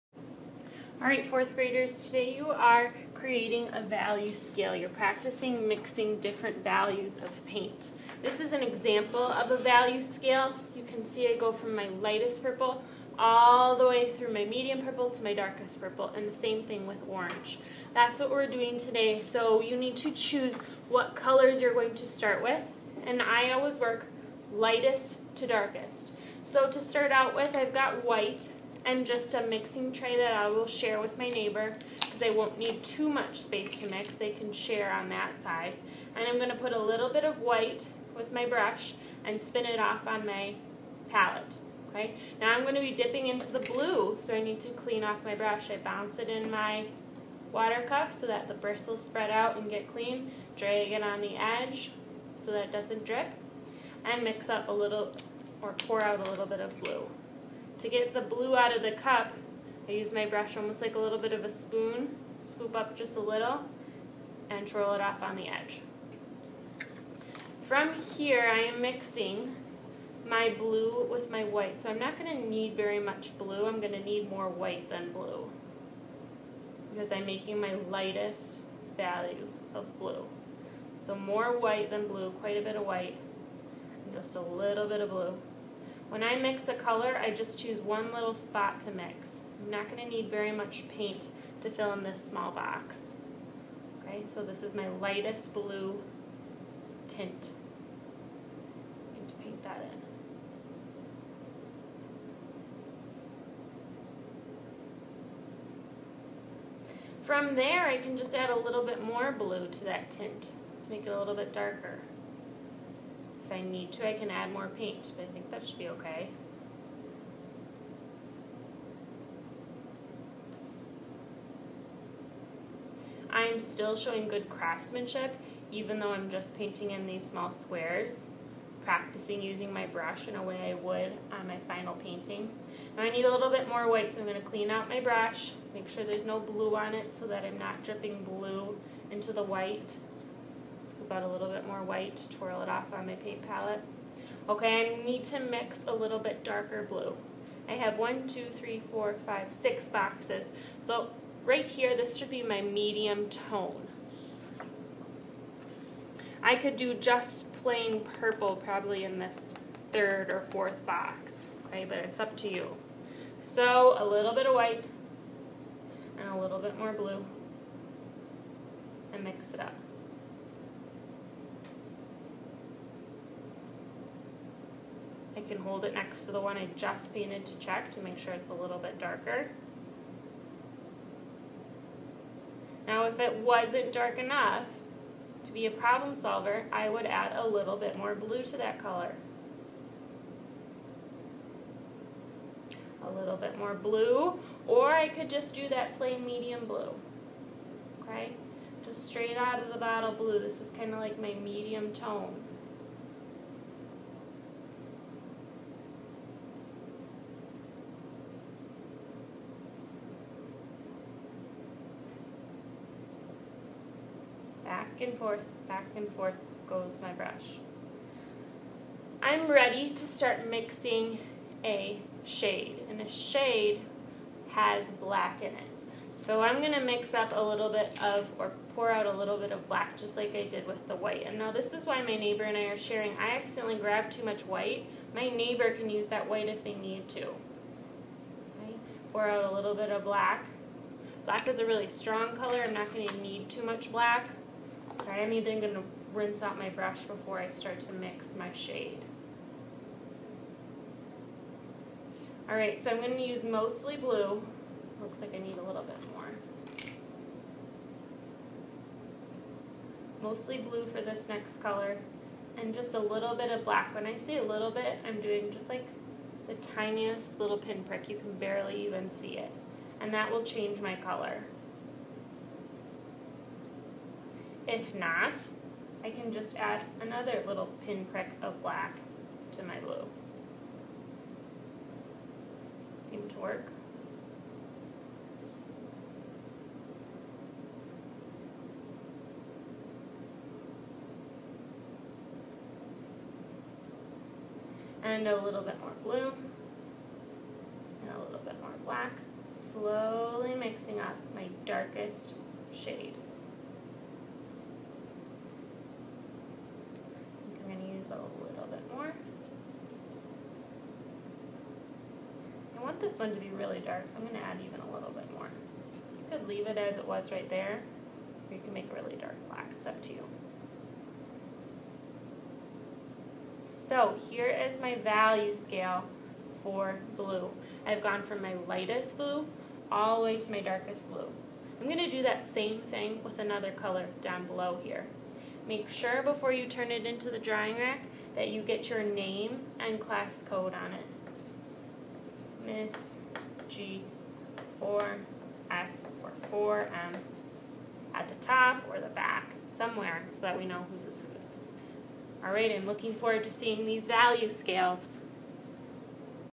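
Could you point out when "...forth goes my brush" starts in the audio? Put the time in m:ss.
3:36.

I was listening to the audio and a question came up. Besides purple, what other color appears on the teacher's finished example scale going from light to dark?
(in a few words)
orange.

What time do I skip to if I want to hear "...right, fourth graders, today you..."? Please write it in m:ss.
0:01.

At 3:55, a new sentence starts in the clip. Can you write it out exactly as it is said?
My neighbor can use that white if they need to.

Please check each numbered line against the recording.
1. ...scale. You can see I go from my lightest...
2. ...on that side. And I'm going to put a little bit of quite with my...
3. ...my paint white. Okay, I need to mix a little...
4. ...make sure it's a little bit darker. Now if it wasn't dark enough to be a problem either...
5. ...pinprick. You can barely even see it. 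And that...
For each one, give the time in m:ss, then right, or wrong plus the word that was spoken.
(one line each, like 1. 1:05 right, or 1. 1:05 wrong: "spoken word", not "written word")
1. 0:10 right
2. 0:34 wrong: "white", not "quite"
3. 2:23 wrong: "palette", not "white"
4. 2:58 wrong: "solver", not "either"
5. 4:27 right.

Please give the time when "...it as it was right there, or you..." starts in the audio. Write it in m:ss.
5:16.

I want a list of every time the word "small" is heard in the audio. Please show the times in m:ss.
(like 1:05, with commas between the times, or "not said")
1:32, 2:07.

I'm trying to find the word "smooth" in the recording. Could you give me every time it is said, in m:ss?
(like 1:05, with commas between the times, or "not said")
not said.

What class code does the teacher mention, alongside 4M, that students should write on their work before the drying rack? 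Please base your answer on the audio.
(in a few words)
G4S.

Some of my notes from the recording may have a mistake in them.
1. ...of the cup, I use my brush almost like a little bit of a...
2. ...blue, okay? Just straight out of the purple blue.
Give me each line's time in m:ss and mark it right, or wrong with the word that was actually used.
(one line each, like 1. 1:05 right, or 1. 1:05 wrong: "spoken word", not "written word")
1. 0:58 right
2. 3:16 wrong: "bottle", not "purple".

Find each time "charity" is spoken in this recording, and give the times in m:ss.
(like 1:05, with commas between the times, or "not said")
not said.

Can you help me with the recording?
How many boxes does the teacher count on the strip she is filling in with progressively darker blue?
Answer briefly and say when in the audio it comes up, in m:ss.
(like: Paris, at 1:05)
6, at 2:29.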